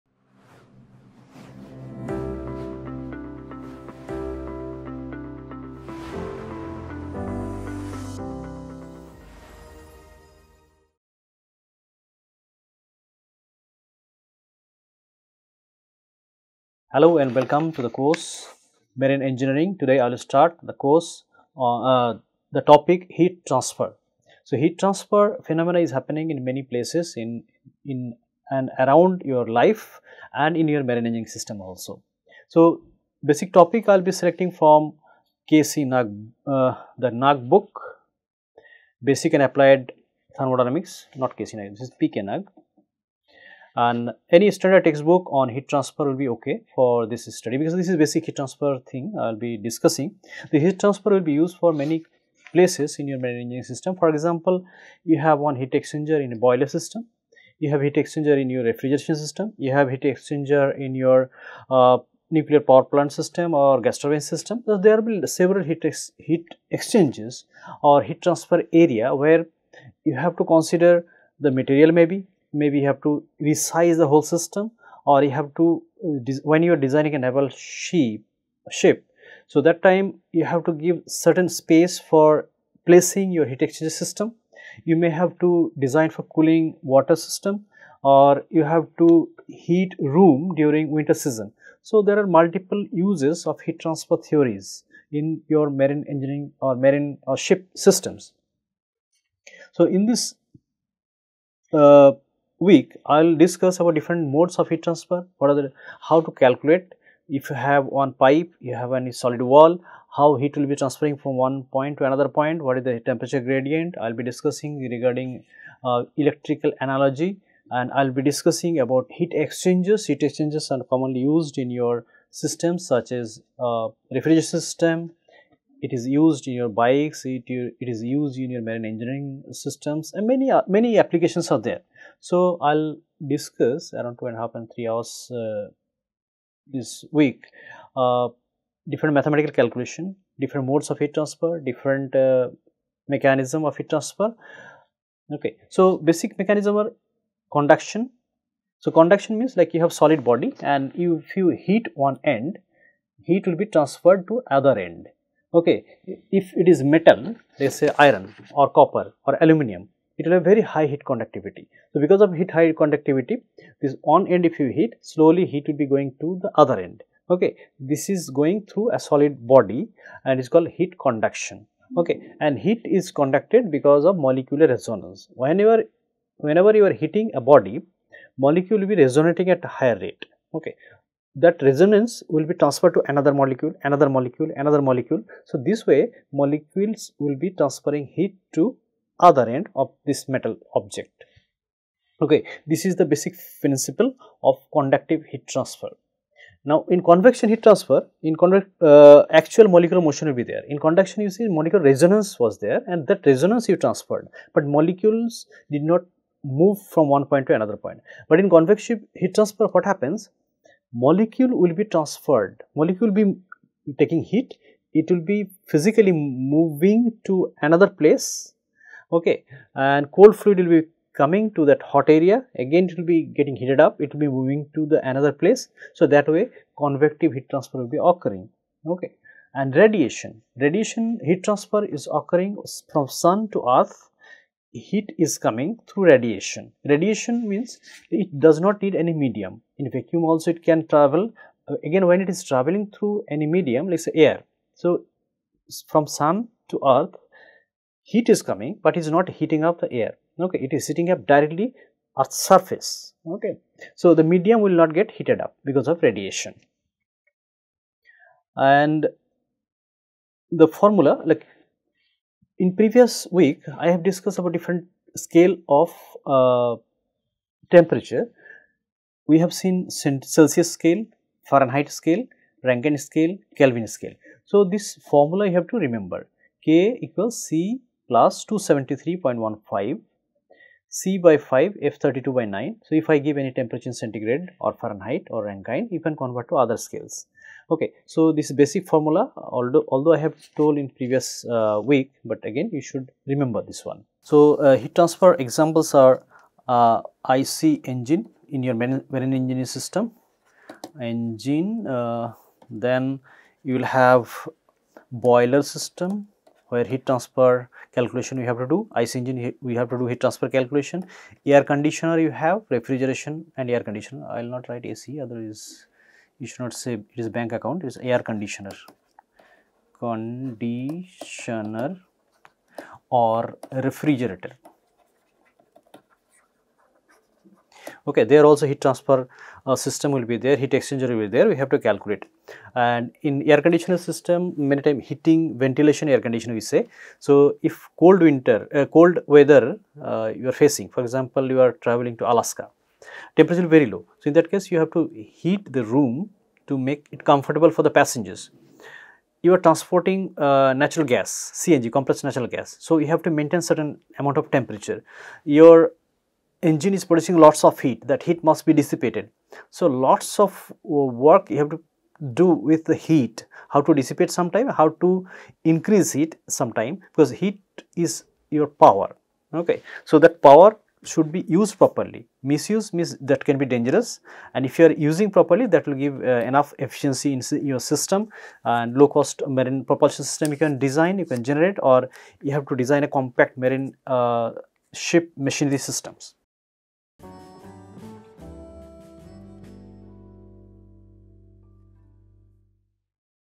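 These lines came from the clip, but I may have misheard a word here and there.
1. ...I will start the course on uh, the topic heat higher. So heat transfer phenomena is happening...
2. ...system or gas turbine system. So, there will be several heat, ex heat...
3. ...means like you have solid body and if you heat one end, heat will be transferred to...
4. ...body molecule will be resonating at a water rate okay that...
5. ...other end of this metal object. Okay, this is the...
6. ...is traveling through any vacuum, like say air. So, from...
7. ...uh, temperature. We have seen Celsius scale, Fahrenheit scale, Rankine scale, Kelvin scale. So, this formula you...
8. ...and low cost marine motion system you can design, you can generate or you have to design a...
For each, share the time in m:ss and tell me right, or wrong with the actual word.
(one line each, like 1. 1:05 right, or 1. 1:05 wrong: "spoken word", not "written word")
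1. 0:20 wrong: "transfer", not "higher"
2. 1:03 right
3. 2:29 right
4. 2:57 wrong: "higher", not "water"
5. 3:09 right
6. 4:02 wrong: "medium", not "vacuum"
7. 4:26 right
8. 6:18 wrong: "propulsion", not "motion".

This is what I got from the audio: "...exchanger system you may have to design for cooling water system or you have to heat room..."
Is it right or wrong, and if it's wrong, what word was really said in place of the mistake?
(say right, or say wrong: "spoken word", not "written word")
right.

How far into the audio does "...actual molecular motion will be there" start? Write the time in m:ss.
3:19.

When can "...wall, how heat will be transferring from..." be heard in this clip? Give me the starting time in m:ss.
1:49.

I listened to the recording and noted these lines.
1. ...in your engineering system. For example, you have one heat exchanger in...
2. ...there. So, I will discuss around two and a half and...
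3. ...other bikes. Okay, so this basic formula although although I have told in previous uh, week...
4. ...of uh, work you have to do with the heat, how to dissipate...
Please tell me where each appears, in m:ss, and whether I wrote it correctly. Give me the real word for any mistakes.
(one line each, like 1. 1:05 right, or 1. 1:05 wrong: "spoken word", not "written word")
1. 0:52 right
2. 2:11 right
3. 4:46 wrong: "scales", not "bikes"
4. 6:00 right.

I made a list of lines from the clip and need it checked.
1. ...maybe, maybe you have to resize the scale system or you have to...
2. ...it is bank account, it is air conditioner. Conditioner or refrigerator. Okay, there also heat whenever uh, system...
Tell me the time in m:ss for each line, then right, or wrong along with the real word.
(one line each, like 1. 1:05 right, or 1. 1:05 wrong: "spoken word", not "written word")
1. 1:11 wrong: "whole", not "scale"
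2. 5:16 wrong: "transfer", not "whenever".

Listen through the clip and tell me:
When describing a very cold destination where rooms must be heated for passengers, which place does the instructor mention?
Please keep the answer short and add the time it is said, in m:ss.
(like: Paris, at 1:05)
Alaska, at 5:42.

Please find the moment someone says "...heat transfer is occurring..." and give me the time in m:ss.
3:51.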